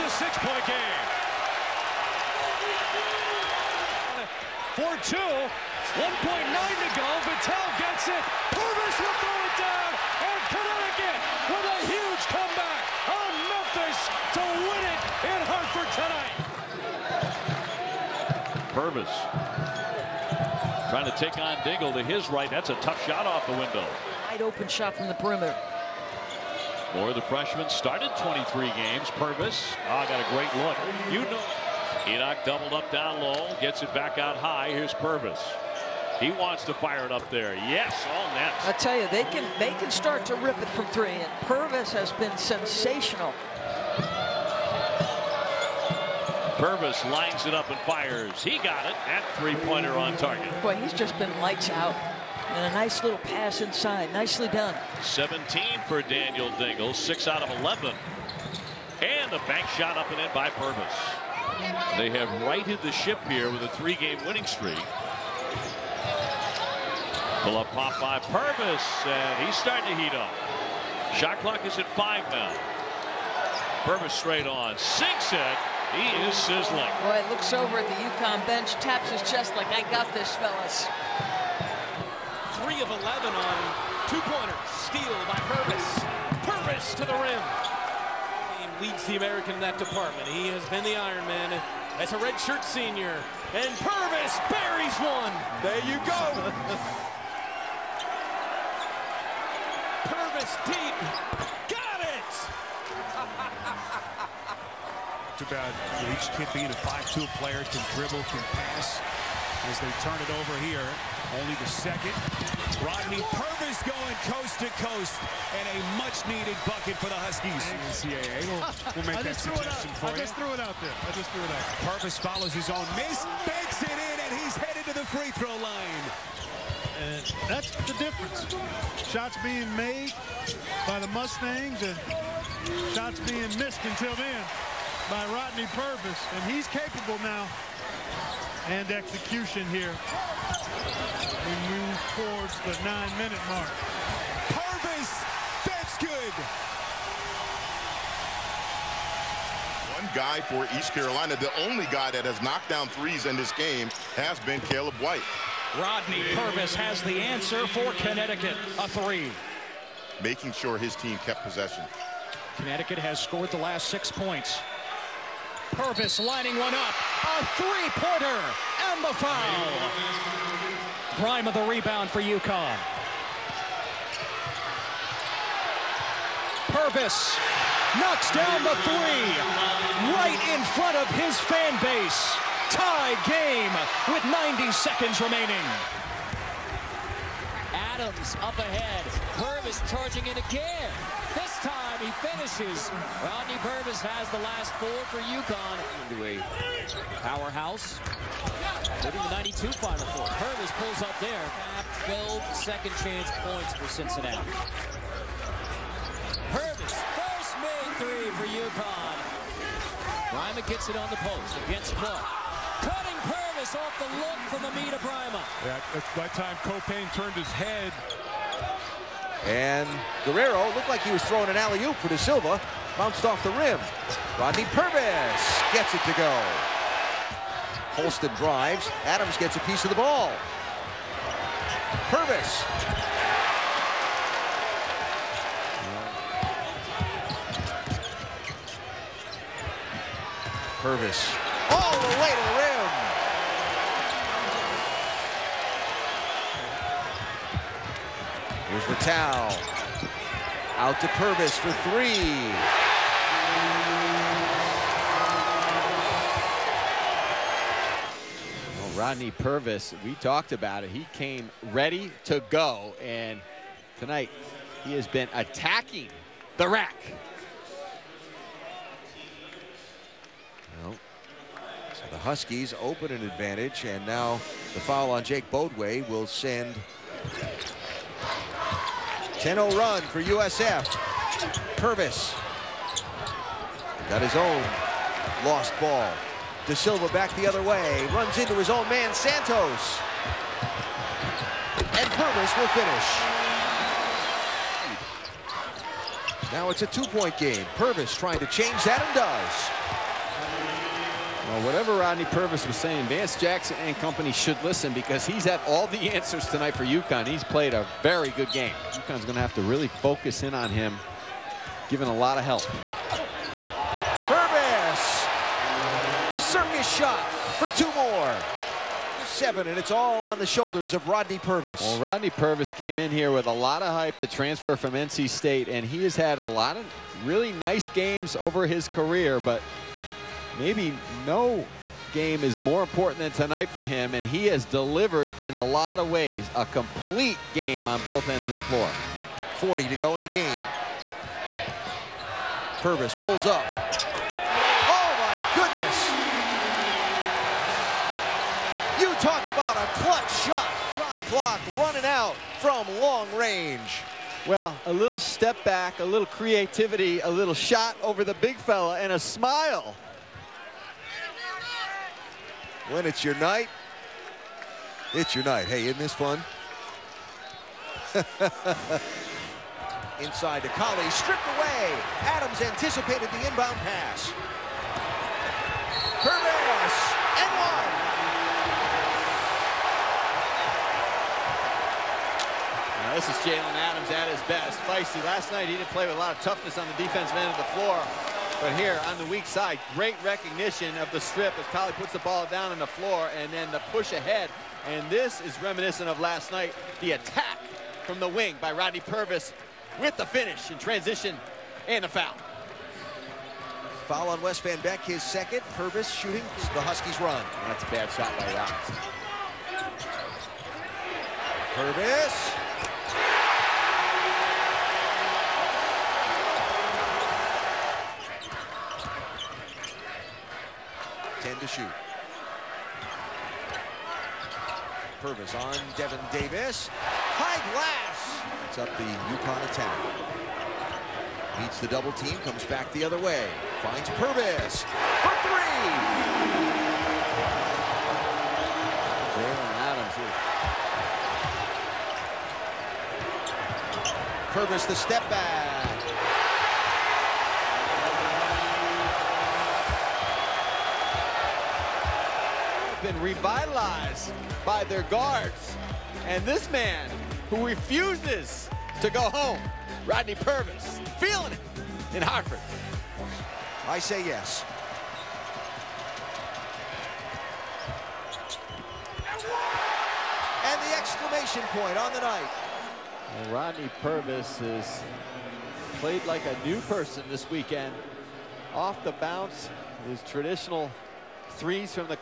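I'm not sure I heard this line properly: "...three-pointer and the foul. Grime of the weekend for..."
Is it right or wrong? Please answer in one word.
wrong.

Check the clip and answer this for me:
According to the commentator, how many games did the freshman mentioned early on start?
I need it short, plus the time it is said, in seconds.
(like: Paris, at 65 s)
23, at 28 s.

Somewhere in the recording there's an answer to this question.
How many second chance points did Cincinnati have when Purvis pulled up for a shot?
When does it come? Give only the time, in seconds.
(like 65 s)
202 s.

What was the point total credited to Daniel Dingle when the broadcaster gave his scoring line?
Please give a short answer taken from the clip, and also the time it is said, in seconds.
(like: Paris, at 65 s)
17, at 55 s.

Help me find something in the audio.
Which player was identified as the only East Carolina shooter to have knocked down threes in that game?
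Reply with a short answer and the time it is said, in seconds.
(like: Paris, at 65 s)
Caleb White, at 154 s.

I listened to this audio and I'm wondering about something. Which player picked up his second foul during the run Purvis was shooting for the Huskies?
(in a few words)
West Van Beck.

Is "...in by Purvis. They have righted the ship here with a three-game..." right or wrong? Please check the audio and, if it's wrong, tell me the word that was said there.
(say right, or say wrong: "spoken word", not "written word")
right.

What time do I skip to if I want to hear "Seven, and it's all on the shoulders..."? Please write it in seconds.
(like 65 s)
319 s.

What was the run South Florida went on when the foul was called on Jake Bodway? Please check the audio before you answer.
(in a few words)
10-0.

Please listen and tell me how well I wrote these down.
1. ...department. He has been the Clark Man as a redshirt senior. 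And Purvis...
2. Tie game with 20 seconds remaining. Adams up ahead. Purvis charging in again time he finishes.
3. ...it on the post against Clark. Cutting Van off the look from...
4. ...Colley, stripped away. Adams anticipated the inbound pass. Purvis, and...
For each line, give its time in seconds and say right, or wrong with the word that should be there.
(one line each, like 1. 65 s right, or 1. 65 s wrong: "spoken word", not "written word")
1. 89 s wrong: "Iron", not "Clark"
2. 182 s wrong: "90", not "20"
3. 210 s wrong: "Purvis", not "Van"
4. 370 s right.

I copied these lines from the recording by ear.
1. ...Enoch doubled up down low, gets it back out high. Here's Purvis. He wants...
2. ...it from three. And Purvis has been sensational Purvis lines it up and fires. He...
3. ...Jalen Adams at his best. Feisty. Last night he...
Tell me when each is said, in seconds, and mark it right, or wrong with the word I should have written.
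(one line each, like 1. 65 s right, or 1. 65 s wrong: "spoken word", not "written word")
1. 32 s right
2. 40 s right
3. 383 s right.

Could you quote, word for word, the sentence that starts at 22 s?
That's a tough shot off the window.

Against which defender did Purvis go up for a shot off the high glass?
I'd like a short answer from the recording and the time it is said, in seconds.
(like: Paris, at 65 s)
Devin Davis, at 425 s.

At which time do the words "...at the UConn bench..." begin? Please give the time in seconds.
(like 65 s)
77 s.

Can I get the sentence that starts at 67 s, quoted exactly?
Pull up pop by Purvis, and he's starting to heat up.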